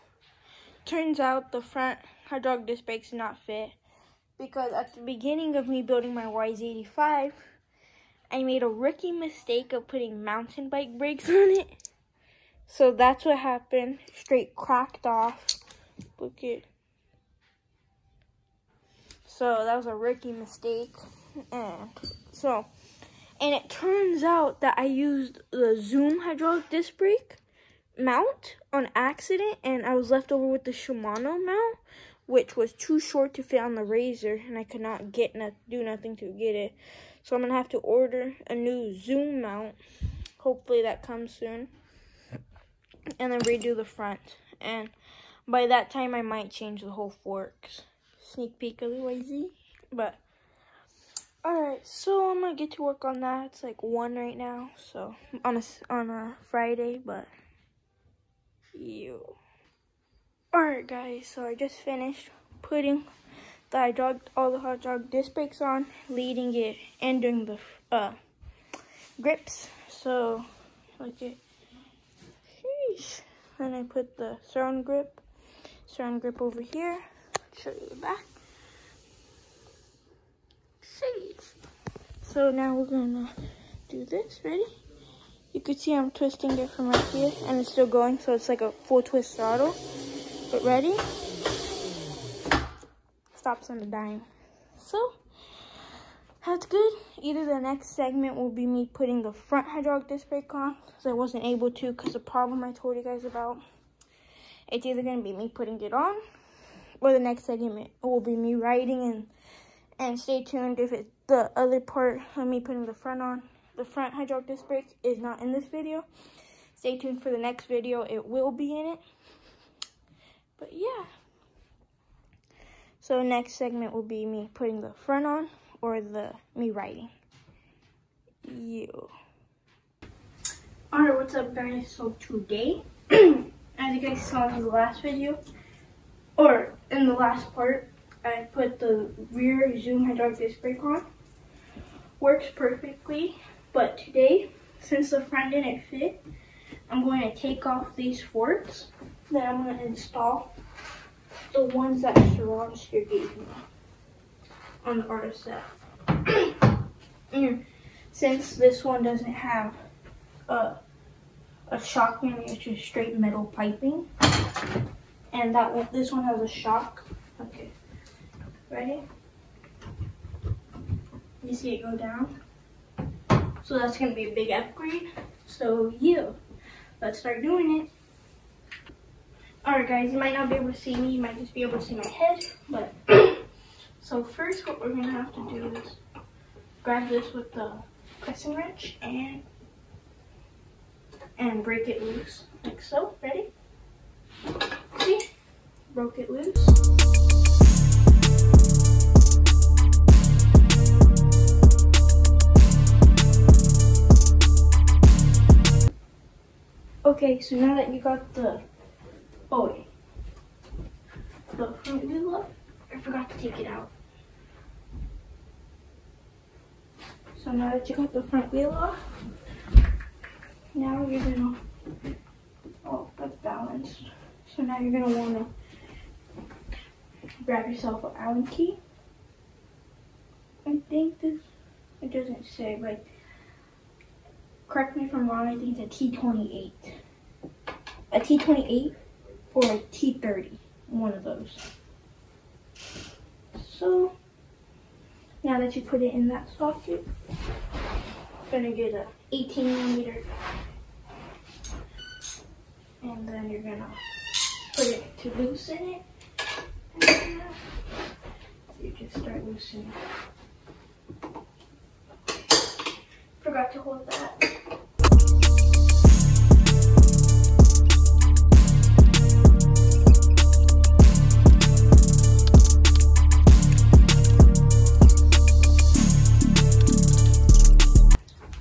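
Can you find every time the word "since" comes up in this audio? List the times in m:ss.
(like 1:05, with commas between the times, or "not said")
2:24, 2:38.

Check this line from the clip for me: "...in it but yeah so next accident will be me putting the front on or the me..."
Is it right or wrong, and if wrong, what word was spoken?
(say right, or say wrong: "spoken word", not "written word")
wrong: "segment", not "accident".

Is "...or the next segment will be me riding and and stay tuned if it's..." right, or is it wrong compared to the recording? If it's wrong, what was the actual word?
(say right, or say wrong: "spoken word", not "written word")
right.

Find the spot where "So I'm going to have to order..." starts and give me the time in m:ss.
0:37.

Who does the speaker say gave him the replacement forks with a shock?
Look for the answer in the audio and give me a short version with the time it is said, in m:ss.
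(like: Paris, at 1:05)
Surroundster, at 2:32.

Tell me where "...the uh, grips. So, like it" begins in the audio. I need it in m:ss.
1:07.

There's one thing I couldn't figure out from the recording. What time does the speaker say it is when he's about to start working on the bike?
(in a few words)
1.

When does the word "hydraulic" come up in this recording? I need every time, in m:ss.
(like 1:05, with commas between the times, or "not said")
0:26, 1:39, 1:54, 2:20.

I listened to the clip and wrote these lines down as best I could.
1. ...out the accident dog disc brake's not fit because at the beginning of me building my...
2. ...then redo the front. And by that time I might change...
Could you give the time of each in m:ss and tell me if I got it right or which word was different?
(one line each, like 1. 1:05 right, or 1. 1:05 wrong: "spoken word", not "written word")
1. 0:01 wrong: "front", not "accident"
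2. 0:43 right.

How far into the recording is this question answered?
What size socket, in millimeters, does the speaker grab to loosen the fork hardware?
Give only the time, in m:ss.
4:09.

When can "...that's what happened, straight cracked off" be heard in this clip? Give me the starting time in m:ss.
0:12.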